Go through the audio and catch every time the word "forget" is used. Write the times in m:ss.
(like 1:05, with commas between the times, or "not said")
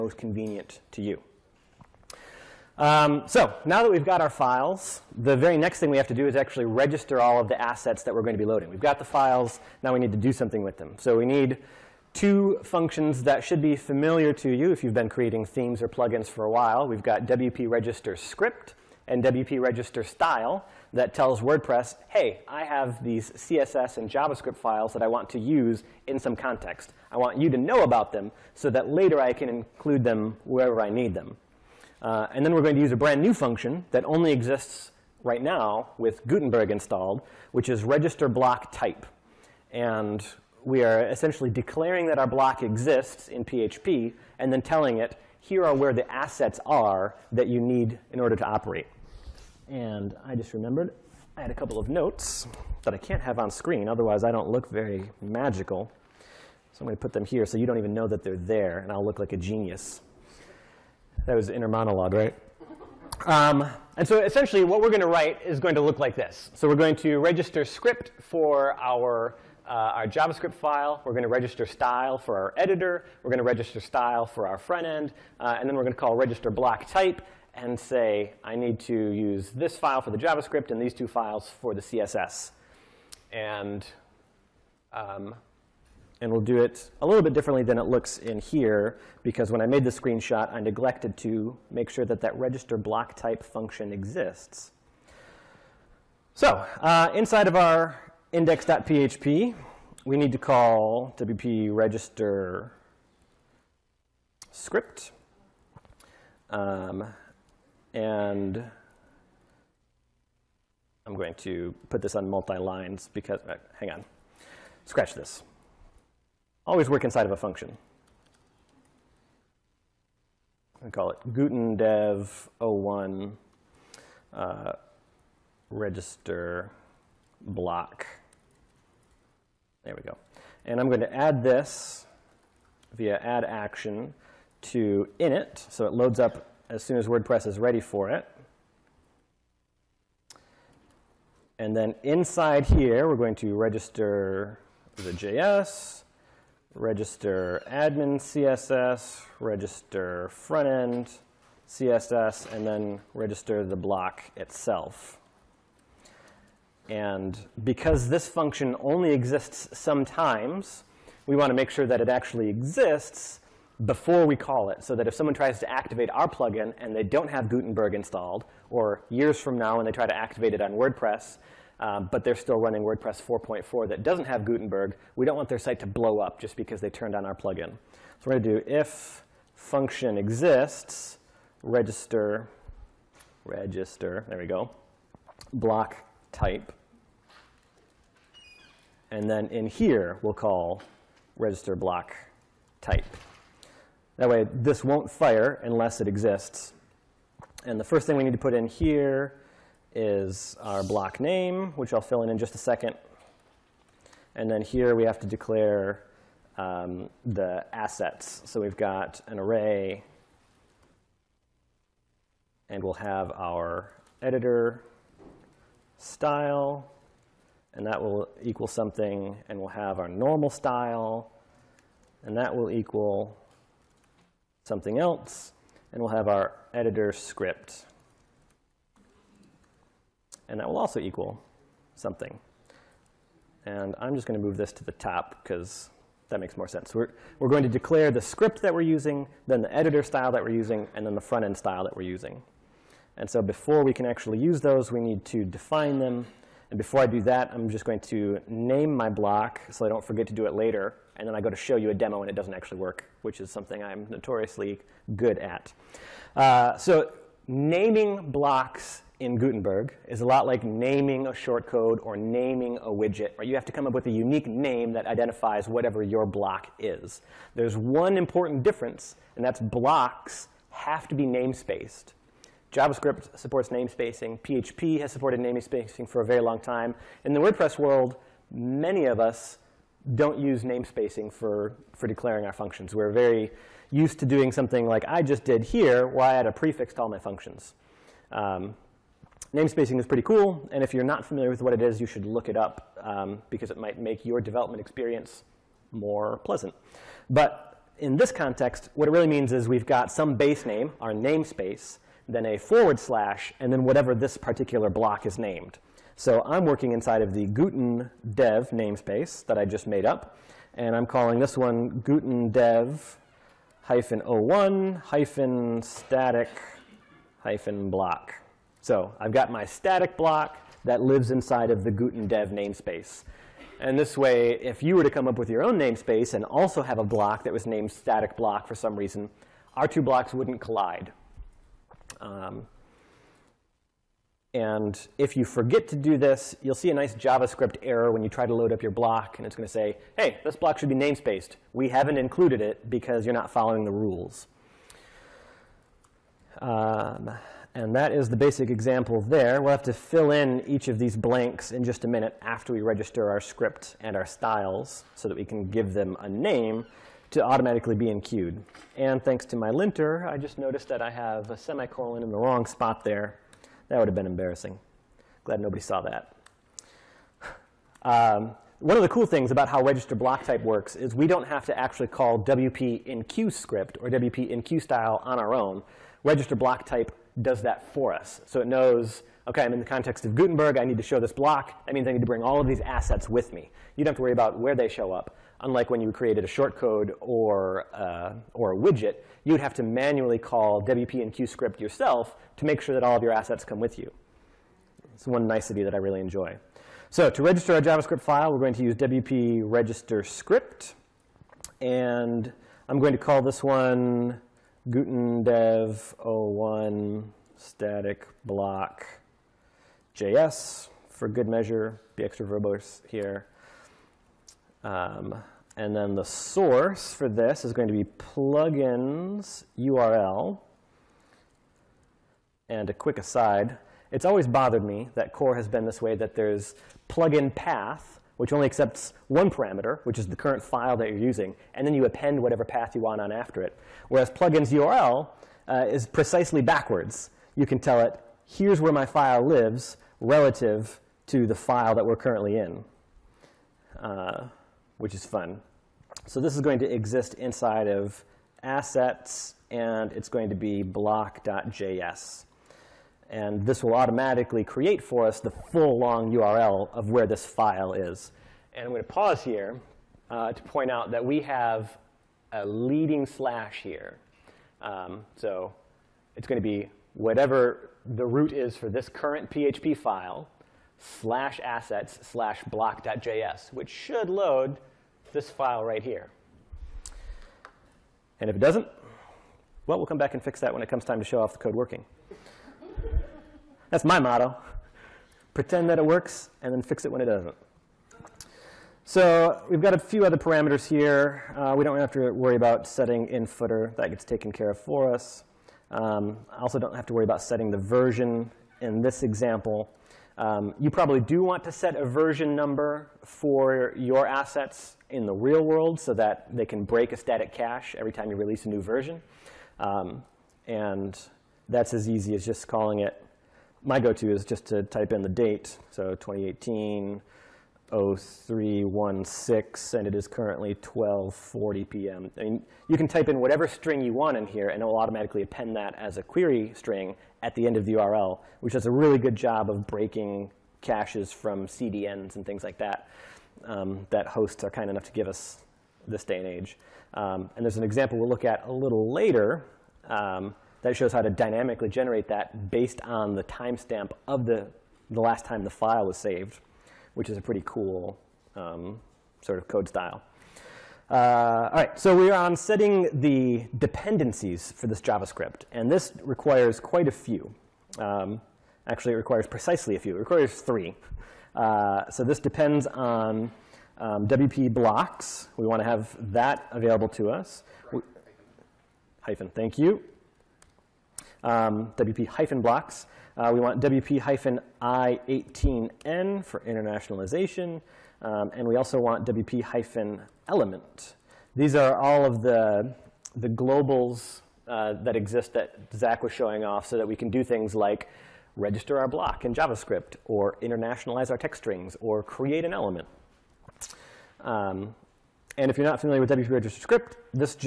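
4:10, 5:35.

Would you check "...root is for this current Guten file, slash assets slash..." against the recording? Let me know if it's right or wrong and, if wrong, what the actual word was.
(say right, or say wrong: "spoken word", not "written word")
wrong: "PHP", not "Guten".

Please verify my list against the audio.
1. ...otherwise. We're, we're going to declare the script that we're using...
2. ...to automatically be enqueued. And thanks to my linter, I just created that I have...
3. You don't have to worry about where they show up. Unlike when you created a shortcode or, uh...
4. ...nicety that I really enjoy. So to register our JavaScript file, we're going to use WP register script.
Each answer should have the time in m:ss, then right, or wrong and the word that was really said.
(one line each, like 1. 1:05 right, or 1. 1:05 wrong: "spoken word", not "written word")
1. 3:56 wrong: "sense", not "otherwise"
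2. 5:57 wrong: "noticed", not "created"
3. 6:23 right
4. 6:35 right.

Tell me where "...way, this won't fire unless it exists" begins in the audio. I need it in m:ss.
3:14.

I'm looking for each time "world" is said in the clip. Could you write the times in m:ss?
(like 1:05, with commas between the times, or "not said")
4:37, 8:25.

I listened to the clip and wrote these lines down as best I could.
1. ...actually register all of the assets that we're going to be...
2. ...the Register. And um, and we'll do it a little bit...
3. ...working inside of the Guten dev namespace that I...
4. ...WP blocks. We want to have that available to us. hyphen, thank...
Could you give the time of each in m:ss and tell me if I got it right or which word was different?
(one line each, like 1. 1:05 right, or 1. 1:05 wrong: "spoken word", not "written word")
1. 0:06 right
2. 1:21 wrong: "CSS", not "Register"
3. 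5:06 right
4. 9:24 right.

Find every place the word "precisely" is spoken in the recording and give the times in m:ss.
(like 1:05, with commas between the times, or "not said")
7:16, 9:19.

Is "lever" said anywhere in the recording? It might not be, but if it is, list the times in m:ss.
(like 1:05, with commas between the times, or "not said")
not said.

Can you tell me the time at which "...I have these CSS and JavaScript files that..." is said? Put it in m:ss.
0:22.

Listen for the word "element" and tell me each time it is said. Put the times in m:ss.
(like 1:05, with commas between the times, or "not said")
9:39, 9:52.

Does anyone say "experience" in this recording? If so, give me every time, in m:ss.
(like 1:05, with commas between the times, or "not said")
4:54.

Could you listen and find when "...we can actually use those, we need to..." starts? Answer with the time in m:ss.
4:03.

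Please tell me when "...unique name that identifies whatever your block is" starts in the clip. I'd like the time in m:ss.
4:24.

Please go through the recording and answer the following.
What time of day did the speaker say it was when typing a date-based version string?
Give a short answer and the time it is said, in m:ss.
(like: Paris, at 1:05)
12:40 p.m., at 8:40.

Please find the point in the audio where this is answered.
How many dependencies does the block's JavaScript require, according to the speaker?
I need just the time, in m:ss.
9:20.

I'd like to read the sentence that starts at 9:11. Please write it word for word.
Uh, all right, so we are on setting the dependencies for this JavaScript.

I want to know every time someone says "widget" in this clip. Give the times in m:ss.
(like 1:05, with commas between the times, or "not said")
4:22, 6:28.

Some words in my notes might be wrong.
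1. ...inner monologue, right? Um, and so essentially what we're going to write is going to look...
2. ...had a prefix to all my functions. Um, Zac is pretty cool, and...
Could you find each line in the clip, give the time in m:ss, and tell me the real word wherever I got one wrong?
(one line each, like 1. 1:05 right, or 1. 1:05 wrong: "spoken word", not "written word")
1. 1:01 right
2. 4:46 wrong: "Namespacing", not "Zac".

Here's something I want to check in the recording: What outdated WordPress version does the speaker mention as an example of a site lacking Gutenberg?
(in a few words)
4.4.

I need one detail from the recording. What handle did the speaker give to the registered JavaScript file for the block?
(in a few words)
Gutendev 01 static block JS.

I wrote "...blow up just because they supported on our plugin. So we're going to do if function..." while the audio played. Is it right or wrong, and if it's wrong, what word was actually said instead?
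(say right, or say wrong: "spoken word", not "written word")
wrong: "turned", not "supported".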